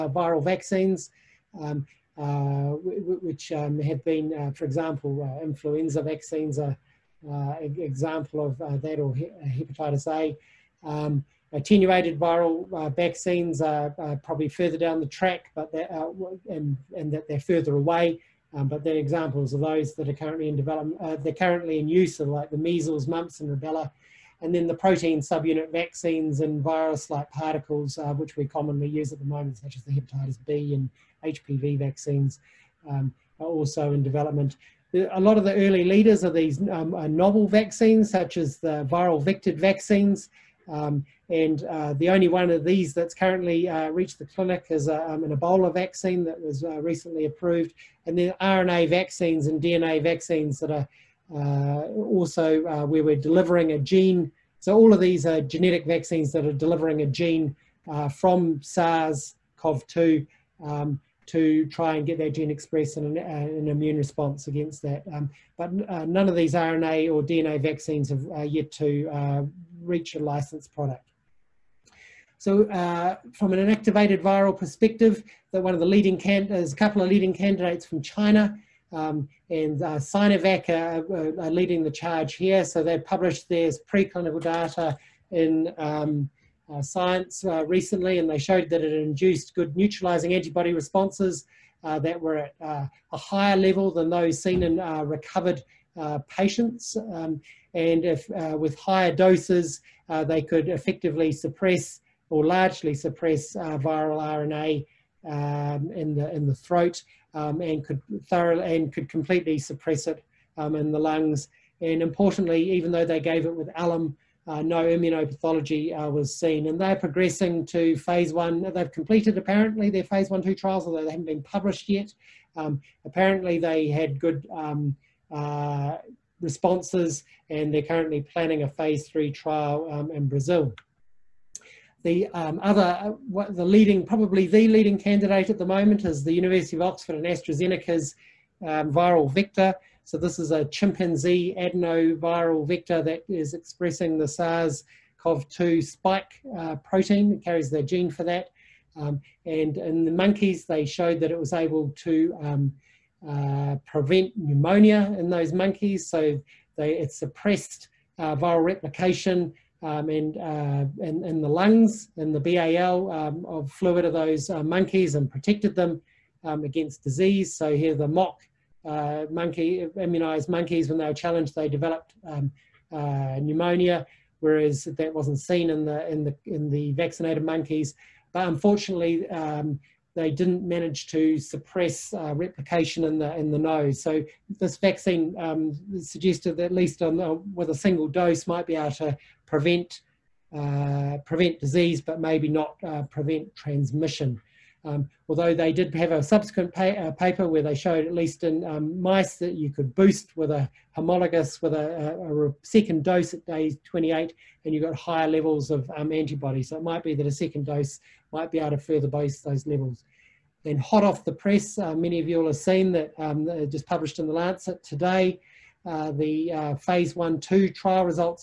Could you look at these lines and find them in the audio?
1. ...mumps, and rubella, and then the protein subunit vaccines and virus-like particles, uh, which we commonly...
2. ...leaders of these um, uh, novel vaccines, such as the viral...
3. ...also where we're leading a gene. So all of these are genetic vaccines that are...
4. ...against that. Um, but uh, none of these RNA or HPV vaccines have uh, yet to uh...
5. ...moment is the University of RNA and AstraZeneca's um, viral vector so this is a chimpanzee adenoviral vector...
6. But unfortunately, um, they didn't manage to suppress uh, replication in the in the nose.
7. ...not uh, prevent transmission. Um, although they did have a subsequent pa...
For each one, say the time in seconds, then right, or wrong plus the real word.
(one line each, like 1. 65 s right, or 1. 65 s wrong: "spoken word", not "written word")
1. 23 s right
2. 35 s right
3. 51 s wrong: "delivering", not "leading"
4. 64 s wrong: "DNA", not "HPV"
5. 135 s wrong: "Oxford", not "RNA"
6. 178 s right
7. 192 s right.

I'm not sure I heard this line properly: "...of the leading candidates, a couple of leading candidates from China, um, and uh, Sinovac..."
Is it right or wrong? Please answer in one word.
right.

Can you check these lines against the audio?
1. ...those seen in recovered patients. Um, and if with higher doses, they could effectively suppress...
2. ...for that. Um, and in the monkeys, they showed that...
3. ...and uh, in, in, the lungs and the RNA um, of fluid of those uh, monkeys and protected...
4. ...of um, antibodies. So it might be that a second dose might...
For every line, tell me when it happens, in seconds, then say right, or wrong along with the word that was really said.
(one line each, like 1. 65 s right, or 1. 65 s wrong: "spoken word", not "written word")
1. 94 s right
2. 148 s right
3. 160 s wrong: "BAL", not "RNA"
4. 205 s right.